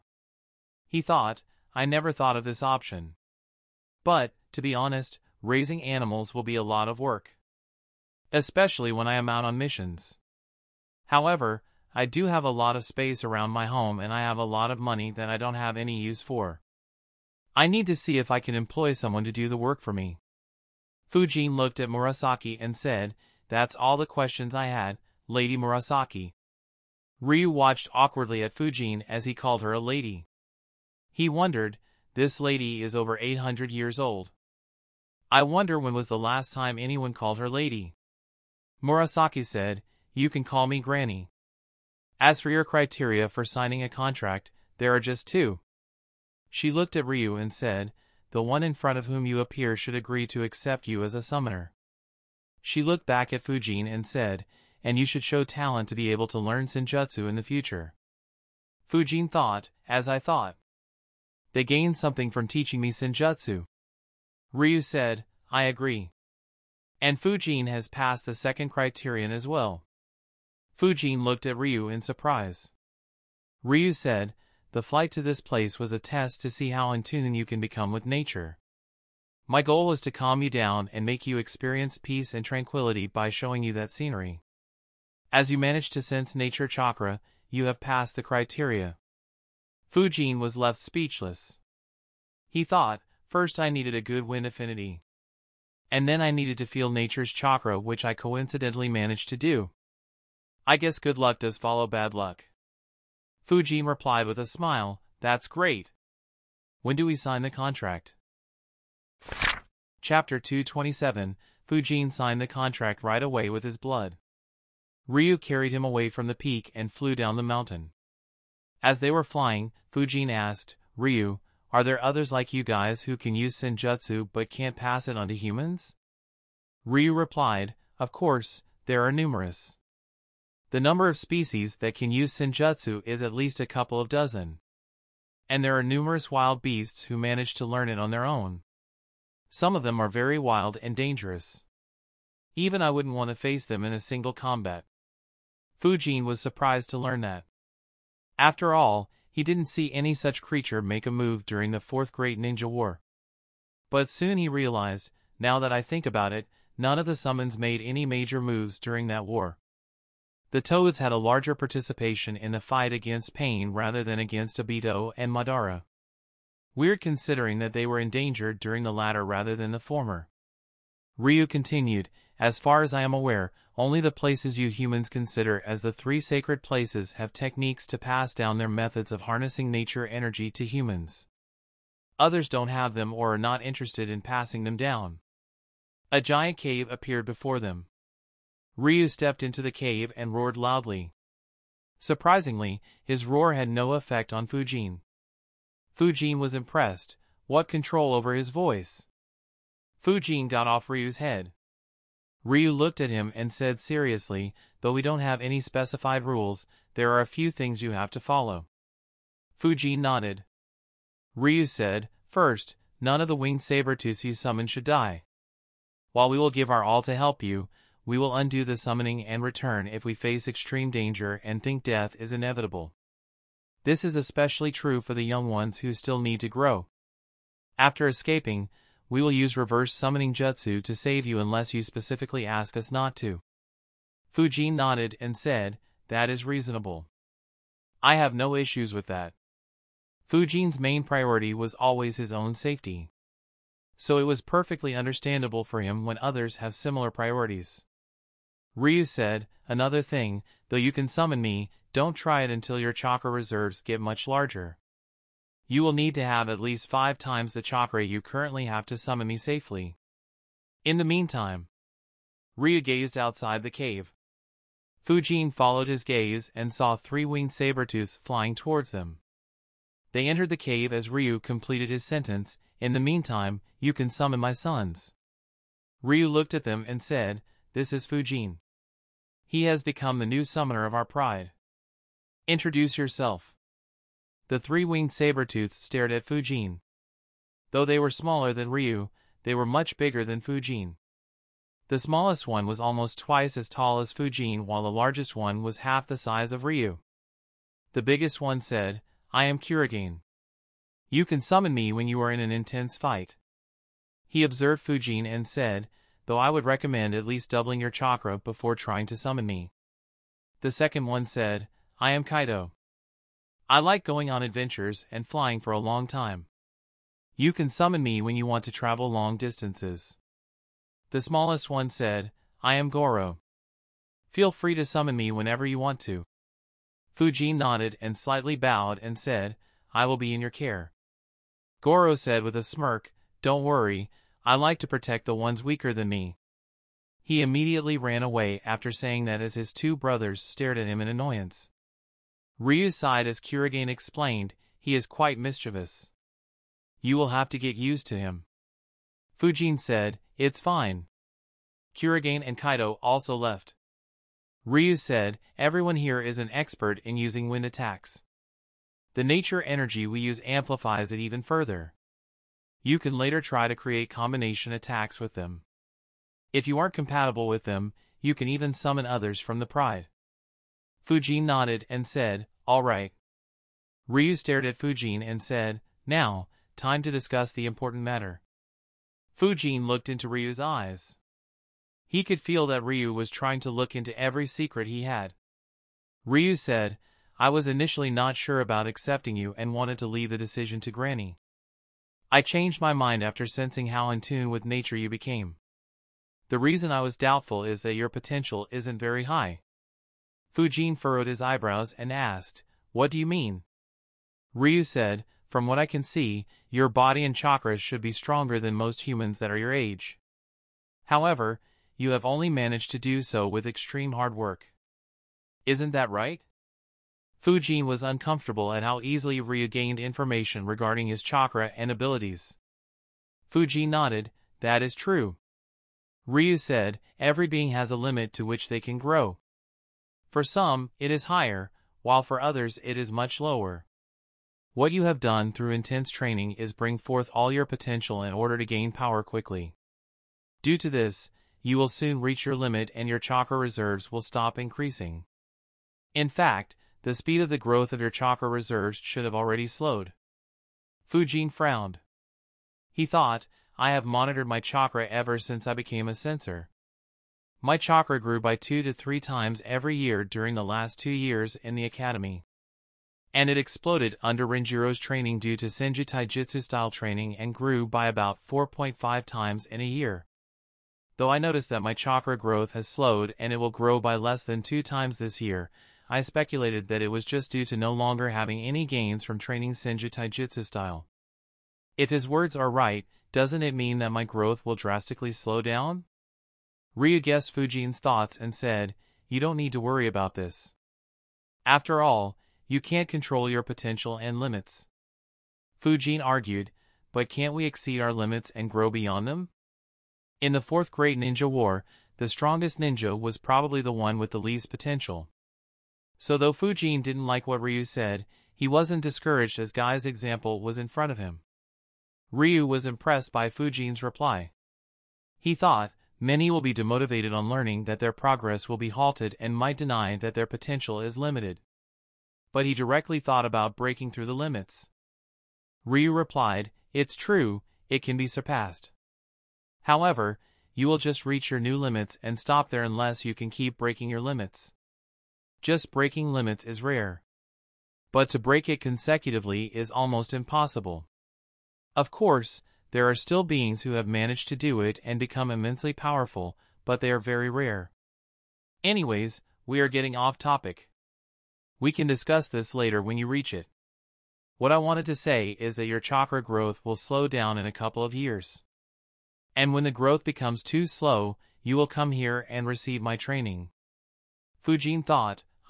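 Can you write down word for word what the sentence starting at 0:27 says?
Ryu watched awkwardly at Fujin as he called her a lady.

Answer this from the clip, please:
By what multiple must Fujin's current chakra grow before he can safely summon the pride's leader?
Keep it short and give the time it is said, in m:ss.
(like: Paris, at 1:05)
5, at 4:16.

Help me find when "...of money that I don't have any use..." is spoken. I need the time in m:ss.
0:14.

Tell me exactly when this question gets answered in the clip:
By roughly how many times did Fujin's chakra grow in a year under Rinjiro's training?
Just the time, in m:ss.
7:48.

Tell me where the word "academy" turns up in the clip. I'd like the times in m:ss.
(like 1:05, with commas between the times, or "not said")
7:41.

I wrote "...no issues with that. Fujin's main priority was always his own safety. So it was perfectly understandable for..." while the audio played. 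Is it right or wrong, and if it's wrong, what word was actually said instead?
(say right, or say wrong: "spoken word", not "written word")
right.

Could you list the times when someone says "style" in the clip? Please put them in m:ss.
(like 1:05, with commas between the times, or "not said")
7:46, 8:00.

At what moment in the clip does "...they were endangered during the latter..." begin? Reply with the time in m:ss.
2:47.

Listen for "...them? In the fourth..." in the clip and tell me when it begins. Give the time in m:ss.
8:19.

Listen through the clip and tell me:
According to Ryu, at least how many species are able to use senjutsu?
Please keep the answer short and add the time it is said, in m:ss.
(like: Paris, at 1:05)
A couple of dozen, at 2:13.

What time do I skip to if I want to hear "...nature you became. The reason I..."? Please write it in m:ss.
6:34.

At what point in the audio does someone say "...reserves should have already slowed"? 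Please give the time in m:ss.
7:28.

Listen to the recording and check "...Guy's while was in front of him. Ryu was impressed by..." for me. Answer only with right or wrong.
wrong.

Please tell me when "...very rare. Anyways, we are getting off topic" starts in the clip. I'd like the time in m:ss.
9:07.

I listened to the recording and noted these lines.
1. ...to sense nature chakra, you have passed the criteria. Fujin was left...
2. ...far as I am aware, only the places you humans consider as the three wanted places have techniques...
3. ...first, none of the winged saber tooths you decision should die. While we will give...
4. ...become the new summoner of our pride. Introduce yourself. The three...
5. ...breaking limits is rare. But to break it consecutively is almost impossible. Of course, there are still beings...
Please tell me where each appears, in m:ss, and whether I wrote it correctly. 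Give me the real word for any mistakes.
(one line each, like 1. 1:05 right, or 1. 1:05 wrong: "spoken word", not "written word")
1. 1:25 right
2. 2:52 wrong: "sacred", not "wanted"
3. 3:32 wrong: "summon", not "decision"
4. 4:39 right
5. 8:55 right.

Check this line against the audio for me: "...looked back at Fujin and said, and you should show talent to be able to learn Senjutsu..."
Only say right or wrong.
right.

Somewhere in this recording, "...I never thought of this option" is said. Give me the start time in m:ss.
0:01.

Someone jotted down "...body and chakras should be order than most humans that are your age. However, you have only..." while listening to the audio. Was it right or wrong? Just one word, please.
wrong.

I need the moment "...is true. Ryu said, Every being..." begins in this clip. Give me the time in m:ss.
7:04.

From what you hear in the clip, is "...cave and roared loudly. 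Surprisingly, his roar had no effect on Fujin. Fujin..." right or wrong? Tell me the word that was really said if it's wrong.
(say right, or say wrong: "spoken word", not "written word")
right.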